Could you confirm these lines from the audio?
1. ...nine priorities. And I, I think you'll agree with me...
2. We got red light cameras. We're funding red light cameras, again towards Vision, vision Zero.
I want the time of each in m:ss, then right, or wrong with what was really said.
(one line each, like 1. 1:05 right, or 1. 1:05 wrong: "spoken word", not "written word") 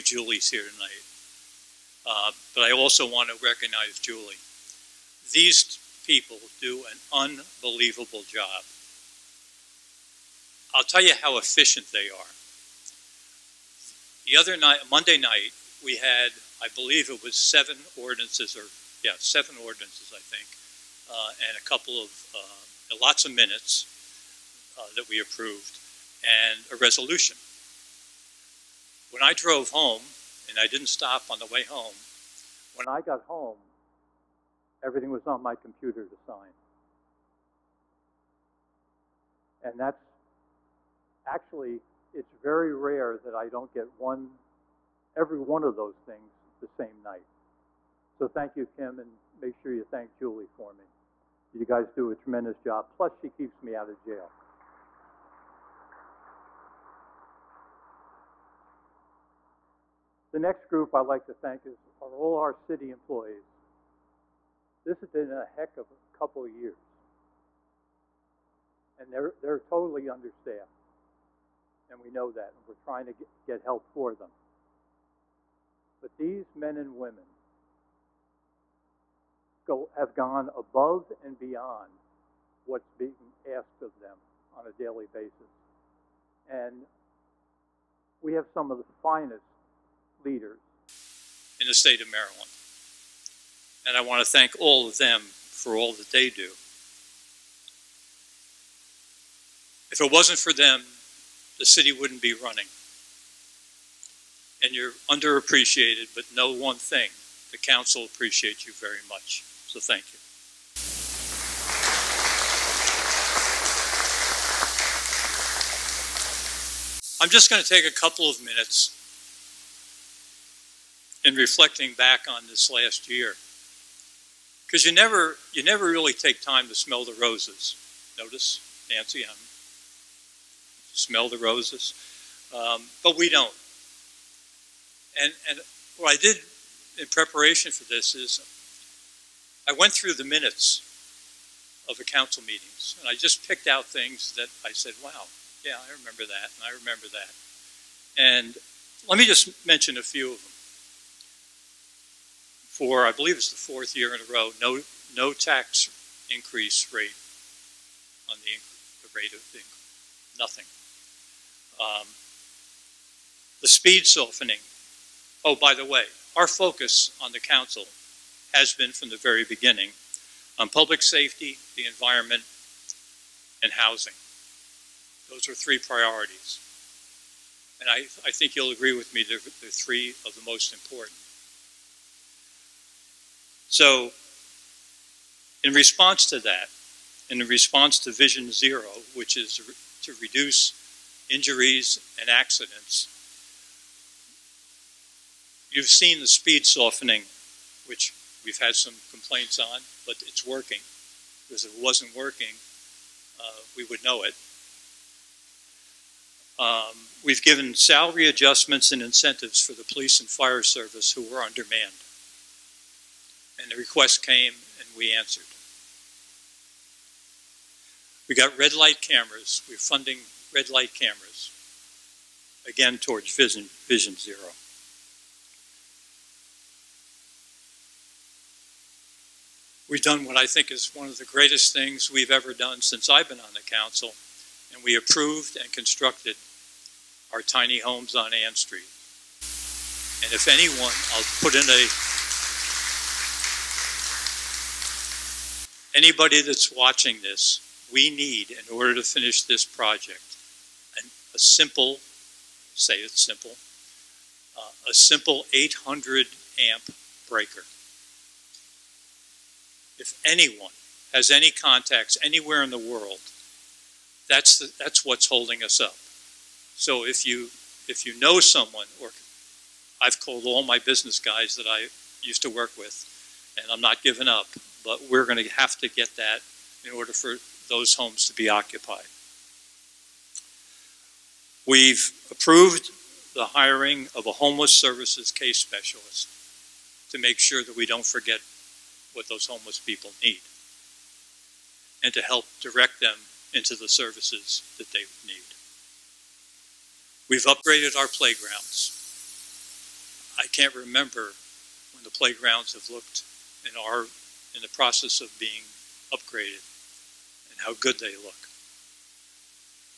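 1. 2:55 wrong: "three", not "nine"
2. 3:38 right.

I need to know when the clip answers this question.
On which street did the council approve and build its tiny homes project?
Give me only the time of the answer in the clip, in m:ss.
3:58.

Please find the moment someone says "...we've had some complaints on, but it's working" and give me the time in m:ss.
3:18.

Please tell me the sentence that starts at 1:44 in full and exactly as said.
And you're underappreciated, but know one thing, the council appreciates you very much.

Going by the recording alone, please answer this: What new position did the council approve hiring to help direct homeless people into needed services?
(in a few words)
homeless services case specialist.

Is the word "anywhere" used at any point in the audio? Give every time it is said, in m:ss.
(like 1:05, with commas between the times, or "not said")
4:22.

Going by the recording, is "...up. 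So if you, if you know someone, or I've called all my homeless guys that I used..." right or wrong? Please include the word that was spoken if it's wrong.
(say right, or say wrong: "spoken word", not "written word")
wrong: "business", not "homeless".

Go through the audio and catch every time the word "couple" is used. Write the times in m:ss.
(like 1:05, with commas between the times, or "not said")
0:21, 1:06, 1:57.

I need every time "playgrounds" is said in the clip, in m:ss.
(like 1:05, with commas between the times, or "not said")
4:58, 5:02.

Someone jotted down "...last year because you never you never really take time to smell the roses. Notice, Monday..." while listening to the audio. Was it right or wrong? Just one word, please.
wrong.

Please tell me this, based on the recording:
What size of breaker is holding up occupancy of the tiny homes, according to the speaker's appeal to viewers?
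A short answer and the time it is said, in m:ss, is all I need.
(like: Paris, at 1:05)
800 amp, at 4:15.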